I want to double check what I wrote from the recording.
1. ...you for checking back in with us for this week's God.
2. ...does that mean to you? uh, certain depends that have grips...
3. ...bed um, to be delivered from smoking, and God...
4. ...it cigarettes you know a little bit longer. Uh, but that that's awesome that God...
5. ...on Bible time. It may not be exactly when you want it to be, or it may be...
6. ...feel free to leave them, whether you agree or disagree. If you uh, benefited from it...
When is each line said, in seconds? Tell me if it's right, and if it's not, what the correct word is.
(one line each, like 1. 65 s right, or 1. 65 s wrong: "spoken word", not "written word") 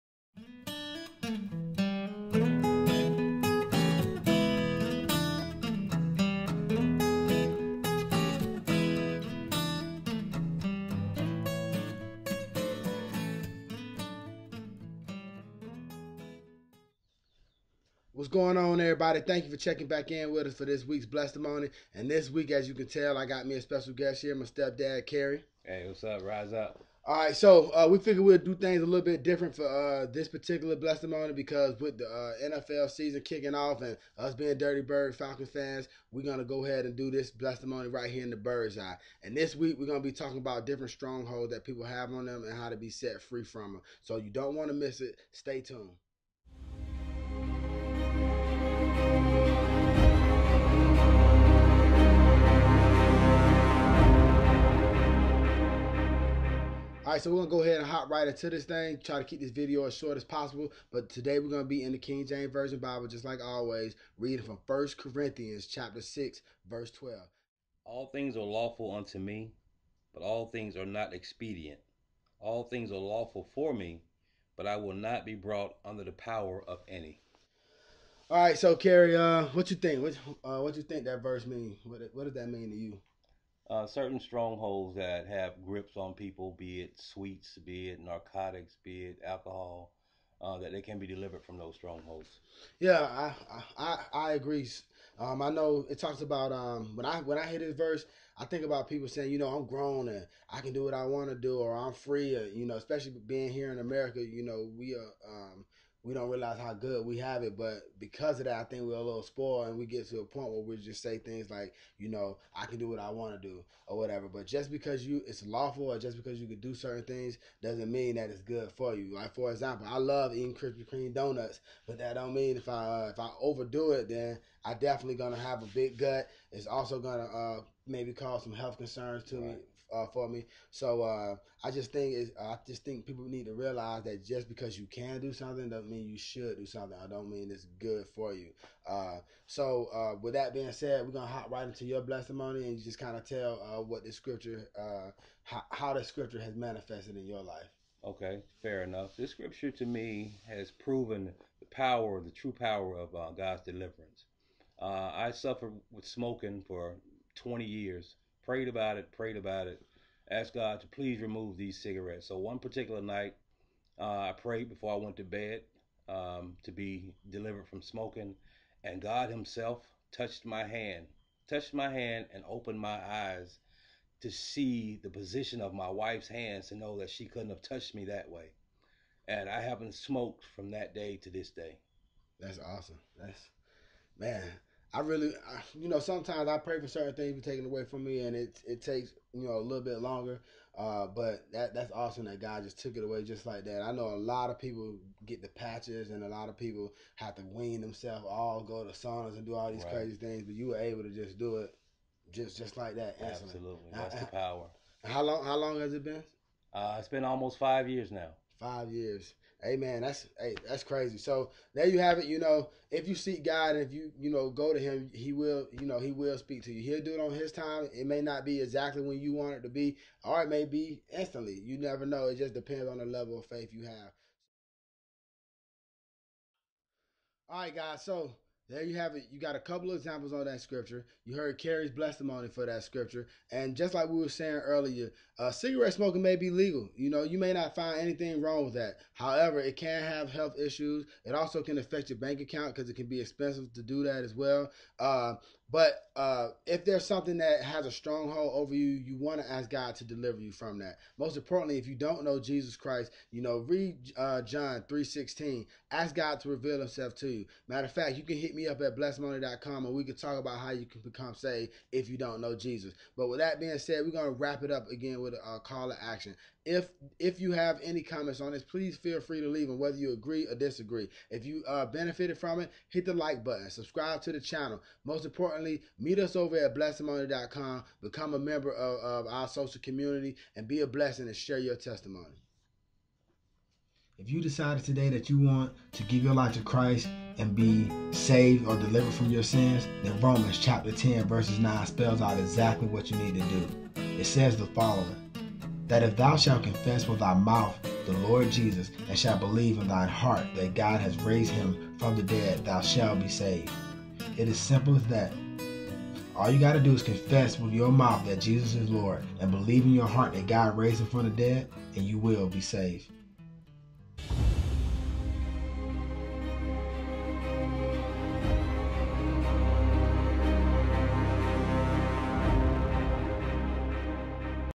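1. 19 s wrong: "Blessedtimony", not "God"
2. 82 s wrong: "strongholds", not "depends"
3. 165 s right
4. 188 s wrong: "takes", not "cigarettes"
5. 217 s wrong: "His", not "Bible"
6. 268 s right.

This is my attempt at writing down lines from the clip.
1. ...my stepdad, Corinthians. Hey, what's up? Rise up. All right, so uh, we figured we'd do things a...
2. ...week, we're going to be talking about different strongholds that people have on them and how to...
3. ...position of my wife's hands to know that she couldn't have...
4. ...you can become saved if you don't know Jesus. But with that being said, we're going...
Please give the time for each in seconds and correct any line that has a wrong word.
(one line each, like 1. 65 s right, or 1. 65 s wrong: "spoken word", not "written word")
1. 24 s wrong: "Kerry", not "Corinthians"
2. 39 s right
3. 175 s right
4. 260 s right.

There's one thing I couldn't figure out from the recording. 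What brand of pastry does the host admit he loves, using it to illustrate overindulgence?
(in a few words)
Krispy Kreme.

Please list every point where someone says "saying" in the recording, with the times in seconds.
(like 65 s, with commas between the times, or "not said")
99 s, 234 s.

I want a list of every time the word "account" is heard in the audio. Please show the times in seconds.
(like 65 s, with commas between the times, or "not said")
242 s.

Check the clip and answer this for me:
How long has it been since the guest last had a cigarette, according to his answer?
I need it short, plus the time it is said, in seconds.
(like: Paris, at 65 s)
Almost 5 years, at 207 s.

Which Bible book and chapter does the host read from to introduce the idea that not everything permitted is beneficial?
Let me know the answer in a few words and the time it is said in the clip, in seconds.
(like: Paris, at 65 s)
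First Corinthians chapter 6, at 64 s.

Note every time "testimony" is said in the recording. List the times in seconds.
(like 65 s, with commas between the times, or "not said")
142 s, 231 s, 281 s.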